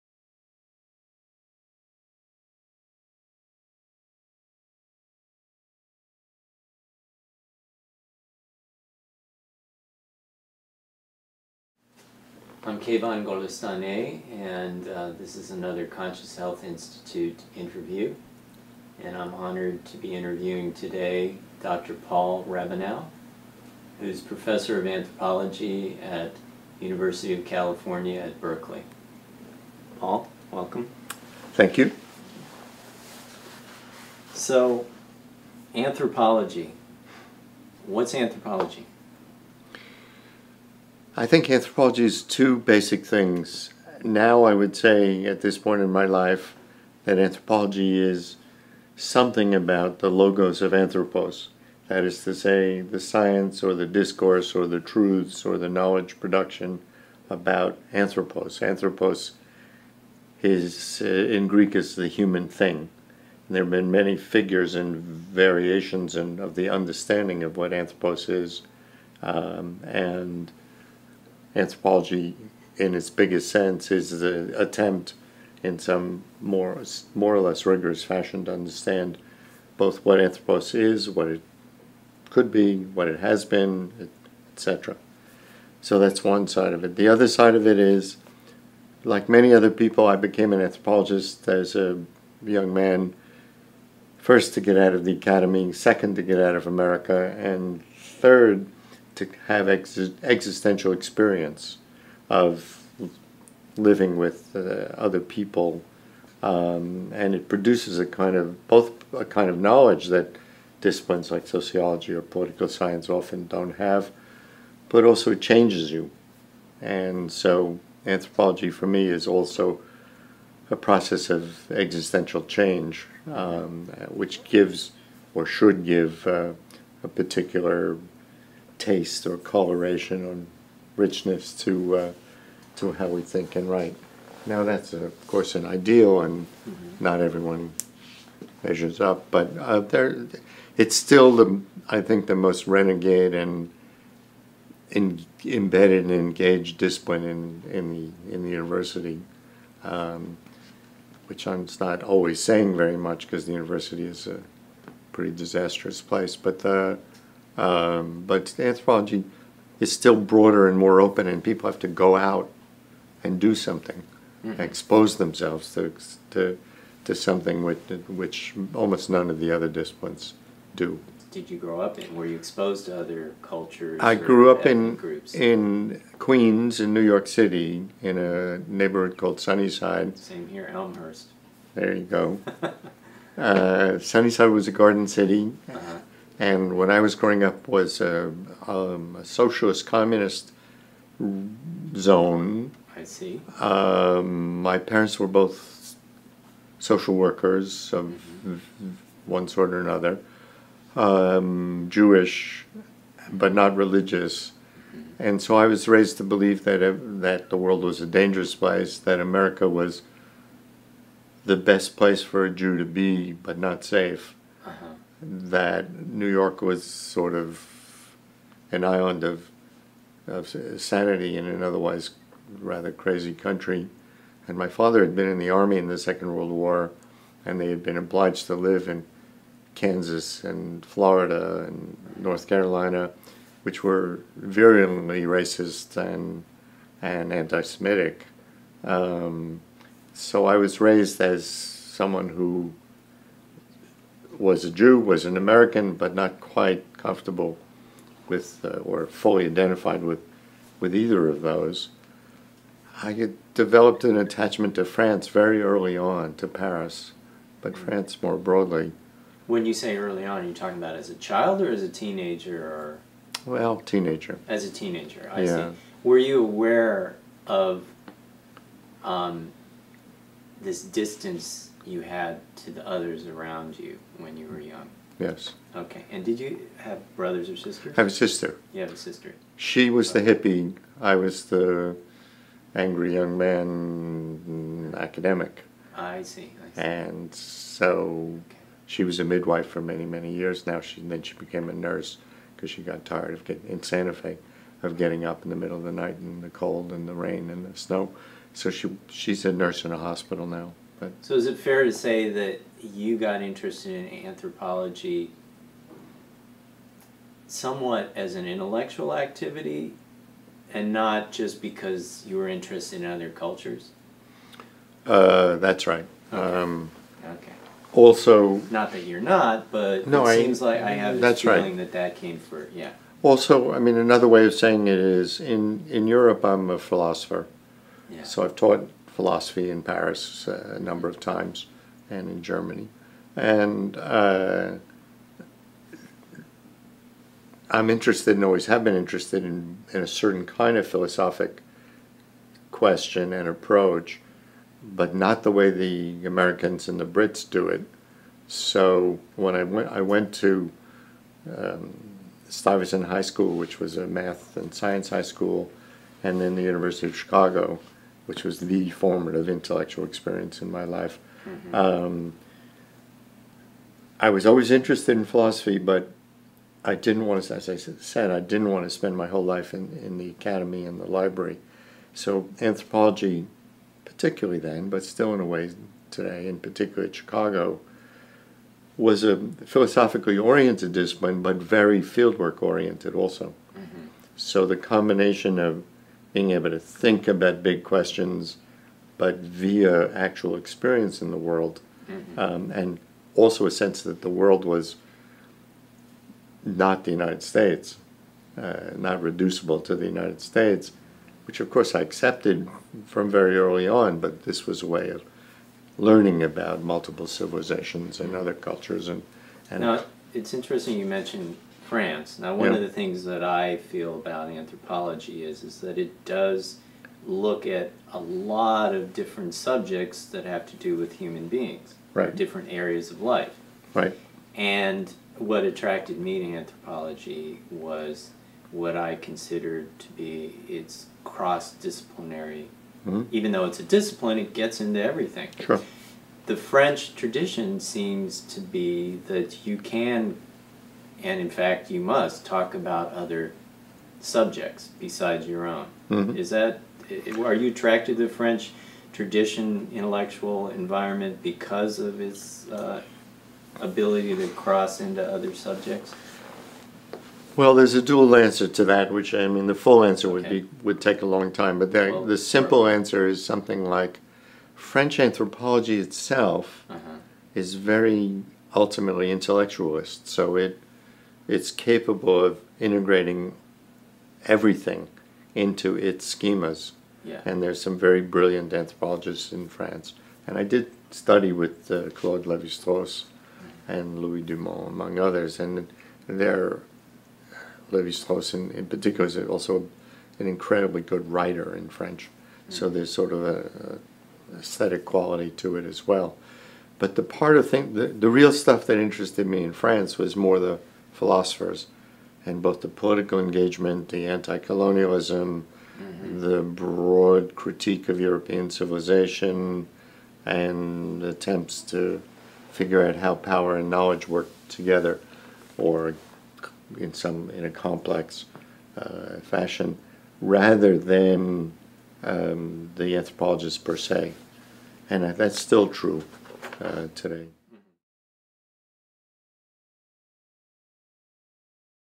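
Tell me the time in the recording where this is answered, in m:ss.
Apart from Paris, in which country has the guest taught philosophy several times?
5:32.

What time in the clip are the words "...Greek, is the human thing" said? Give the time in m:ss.
1:01.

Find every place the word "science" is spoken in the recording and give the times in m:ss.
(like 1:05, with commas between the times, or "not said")
0:52, 1:52, 5:54.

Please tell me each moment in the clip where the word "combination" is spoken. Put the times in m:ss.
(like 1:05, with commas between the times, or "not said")
6:24.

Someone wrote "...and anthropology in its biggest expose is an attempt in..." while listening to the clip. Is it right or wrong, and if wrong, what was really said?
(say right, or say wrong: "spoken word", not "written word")
wrong: "sense", not "expose".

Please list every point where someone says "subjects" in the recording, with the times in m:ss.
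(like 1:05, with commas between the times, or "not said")
6:59, 7:24, 7:35.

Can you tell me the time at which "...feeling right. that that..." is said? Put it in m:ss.
5:21.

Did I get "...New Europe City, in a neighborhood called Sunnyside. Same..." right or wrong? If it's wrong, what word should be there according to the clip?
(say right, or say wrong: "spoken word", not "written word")
wrong: "York", not "Europe".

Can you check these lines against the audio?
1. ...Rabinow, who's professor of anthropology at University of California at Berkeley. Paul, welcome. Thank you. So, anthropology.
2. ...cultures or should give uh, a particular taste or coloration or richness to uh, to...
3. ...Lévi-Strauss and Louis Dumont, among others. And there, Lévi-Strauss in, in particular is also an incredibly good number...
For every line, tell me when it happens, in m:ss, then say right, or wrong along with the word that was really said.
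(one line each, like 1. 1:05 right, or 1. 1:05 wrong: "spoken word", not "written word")
1. 0:22 right
2. 2:04 wrong: "gives", not "cultures"
3. 8:02 wrong: "writer", not "number".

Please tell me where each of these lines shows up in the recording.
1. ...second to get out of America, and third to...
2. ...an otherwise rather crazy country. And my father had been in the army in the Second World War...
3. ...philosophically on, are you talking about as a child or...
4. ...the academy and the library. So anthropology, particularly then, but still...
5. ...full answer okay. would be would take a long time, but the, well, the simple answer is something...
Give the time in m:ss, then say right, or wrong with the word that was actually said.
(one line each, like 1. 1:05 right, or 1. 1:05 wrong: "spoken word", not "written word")
1. 1:35 right
2. 3:41 right
3. 4:19 wrong: "early", not "philosophically"
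4. 6:10 right
5. 7:39 right.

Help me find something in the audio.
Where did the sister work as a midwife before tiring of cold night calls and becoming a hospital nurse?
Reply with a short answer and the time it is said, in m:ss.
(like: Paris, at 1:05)
Santa Fe, at 4:53.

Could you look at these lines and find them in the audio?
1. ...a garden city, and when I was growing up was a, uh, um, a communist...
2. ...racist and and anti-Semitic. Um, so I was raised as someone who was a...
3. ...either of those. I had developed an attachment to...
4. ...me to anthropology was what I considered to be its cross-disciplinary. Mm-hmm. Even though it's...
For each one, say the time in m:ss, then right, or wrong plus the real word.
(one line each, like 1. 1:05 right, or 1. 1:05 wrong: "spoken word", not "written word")
1. 3:04 wrong: "socialist", not "communist"
2. 3:55 right
3. 4:10 right
4. 7:06 right.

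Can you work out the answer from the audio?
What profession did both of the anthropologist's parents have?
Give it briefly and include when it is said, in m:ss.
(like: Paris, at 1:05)
Social workers, at 3:16.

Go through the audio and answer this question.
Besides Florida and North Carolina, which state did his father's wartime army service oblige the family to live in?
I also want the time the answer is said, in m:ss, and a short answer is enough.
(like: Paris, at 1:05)
Kansas, at 3:49.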